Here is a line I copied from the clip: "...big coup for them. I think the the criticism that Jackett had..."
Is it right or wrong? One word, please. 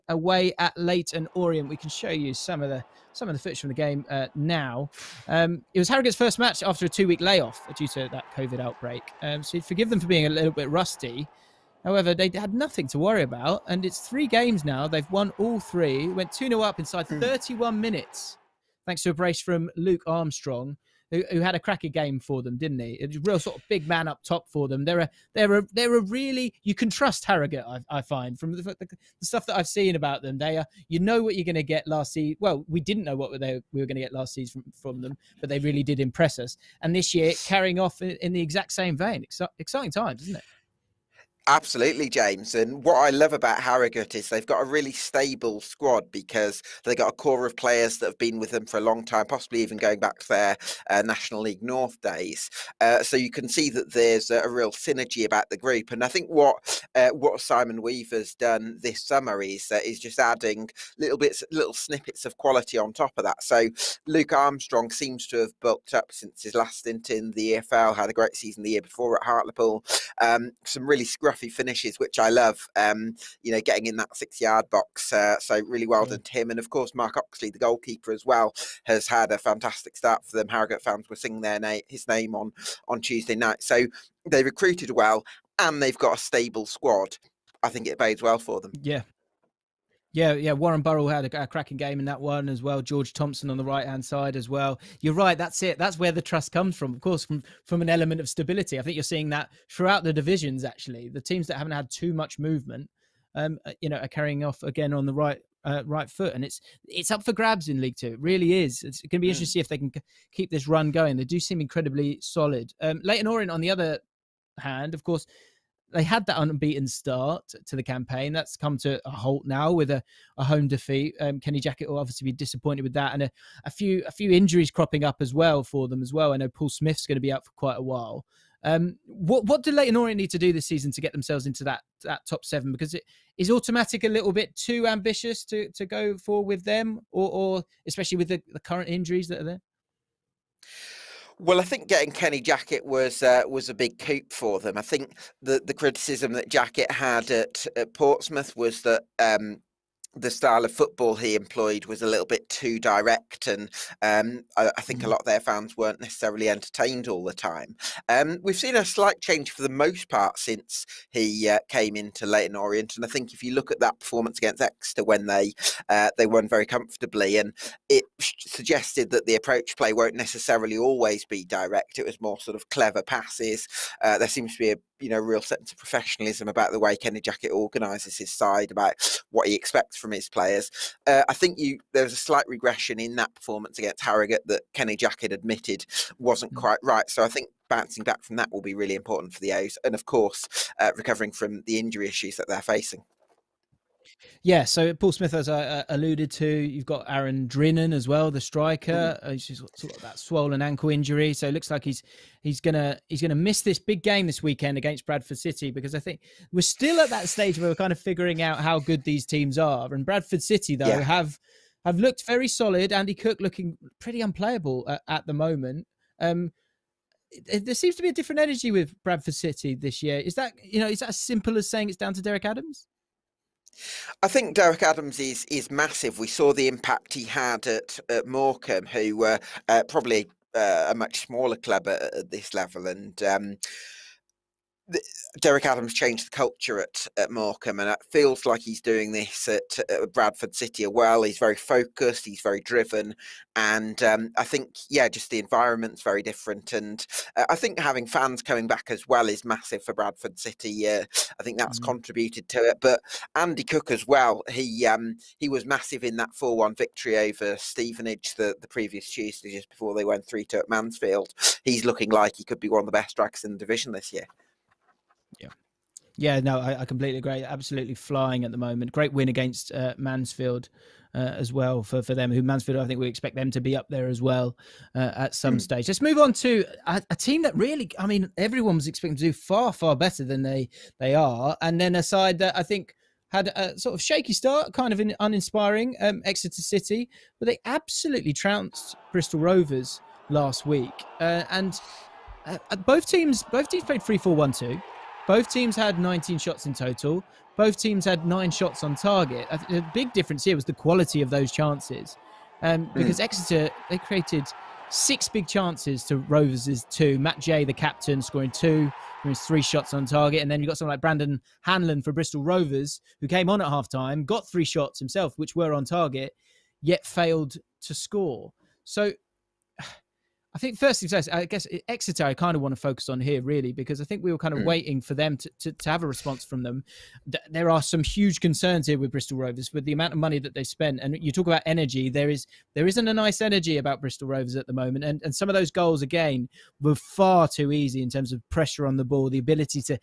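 right.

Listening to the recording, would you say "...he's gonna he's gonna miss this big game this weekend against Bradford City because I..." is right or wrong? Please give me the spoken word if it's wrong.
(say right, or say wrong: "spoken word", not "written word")
right.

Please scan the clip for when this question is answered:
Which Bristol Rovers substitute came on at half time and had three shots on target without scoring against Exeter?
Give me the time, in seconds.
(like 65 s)
311 s.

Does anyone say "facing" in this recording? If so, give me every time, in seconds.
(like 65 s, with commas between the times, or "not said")
192 s.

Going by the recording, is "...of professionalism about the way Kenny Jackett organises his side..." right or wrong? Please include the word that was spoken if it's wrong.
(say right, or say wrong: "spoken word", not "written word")
right.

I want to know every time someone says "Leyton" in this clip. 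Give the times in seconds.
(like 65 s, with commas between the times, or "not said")
0 s, 113 s, 129 s, 162 s.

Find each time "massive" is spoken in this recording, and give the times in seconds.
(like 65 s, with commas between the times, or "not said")
225 s, 249 s, 255 s.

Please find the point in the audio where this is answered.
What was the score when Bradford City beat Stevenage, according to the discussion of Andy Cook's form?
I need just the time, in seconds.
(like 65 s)
256 s.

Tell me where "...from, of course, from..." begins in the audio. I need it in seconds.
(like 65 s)
96 s.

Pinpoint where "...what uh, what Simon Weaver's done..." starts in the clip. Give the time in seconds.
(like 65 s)
56 s.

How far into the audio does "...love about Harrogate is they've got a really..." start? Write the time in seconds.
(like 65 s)
43 s.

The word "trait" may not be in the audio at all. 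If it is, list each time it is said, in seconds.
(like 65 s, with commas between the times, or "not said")
not said.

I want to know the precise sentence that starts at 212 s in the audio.
Andy Cook looking pretty unplayable at, at the moment.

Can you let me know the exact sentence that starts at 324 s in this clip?
waiting for them to, to, to, have a response from them.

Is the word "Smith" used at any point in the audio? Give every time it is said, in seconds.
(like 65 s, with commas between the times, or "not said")
126 s, 195 s.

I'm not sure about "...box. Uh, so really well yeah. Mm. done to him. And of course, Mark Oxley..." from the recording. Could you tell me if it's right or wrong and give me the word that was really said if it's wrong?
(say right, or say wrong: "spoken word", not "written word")
right.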